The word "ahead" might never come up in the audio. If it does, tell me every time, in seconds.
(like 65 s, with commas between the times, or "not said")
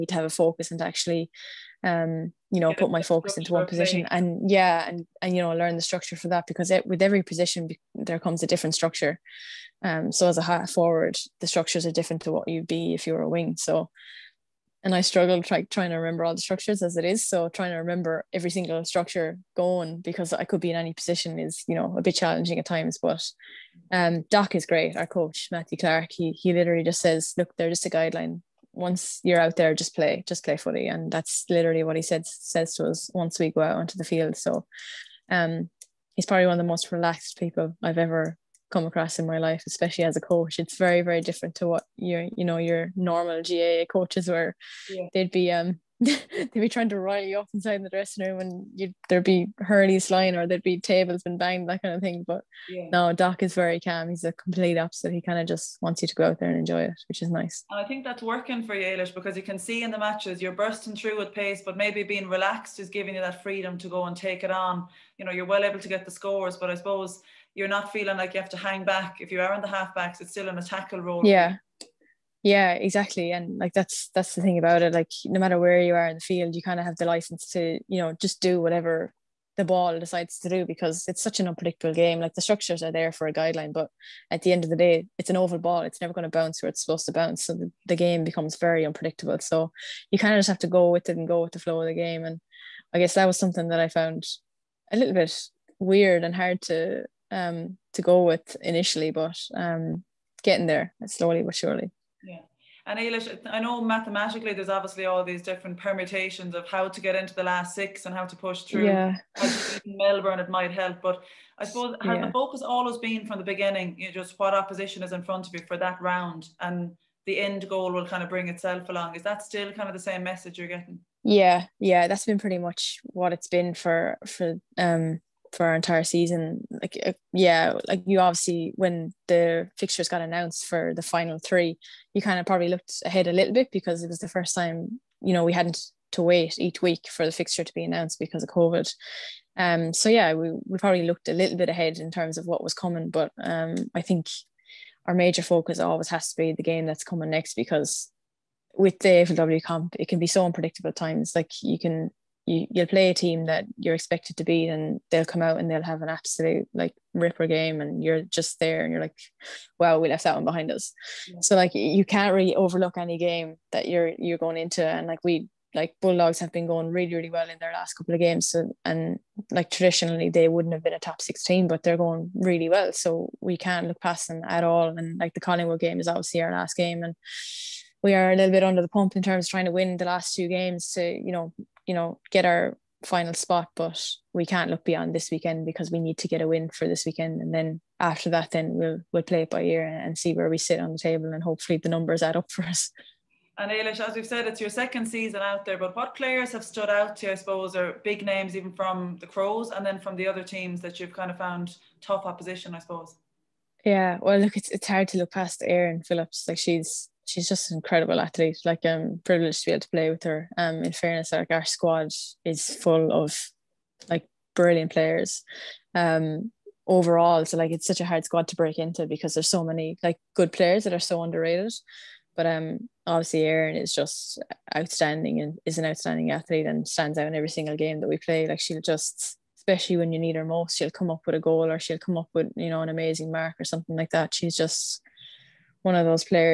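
133 s, 141 s.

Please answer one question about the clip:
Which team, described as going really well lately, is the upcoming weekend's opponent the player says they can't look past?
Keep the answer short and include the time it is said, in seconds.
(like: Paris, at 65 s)
Bulldogs, at 166 s.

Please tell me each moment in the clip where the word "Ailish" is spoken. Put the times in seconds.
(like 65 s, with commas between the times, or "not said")
58 s, 102 s, 193 s.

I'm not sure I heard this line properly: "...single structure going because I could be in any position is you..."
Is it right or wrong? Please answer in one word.
right.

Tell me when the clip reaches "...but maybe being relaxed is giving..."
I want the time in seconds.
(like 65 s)
61 s.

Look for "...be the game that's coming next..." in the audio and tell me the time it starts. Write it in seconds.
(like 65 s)
146 s.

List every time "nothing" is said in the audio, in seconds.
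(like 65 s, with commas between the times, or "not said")
not said.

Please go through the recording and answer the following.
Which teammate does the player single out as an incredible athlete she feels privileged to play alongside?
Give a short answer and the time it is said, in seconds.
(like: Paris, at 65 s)
Erin Phillips, at 205 s.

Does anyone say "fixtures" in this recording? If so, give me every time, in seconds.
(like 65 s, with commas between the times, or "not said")
129 s, 137 s.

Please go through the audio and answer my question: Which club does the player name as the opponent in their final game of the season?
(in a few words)
Collingwood.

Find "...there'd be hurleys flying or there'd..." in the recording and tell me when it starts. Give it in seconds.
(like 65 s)
49 s.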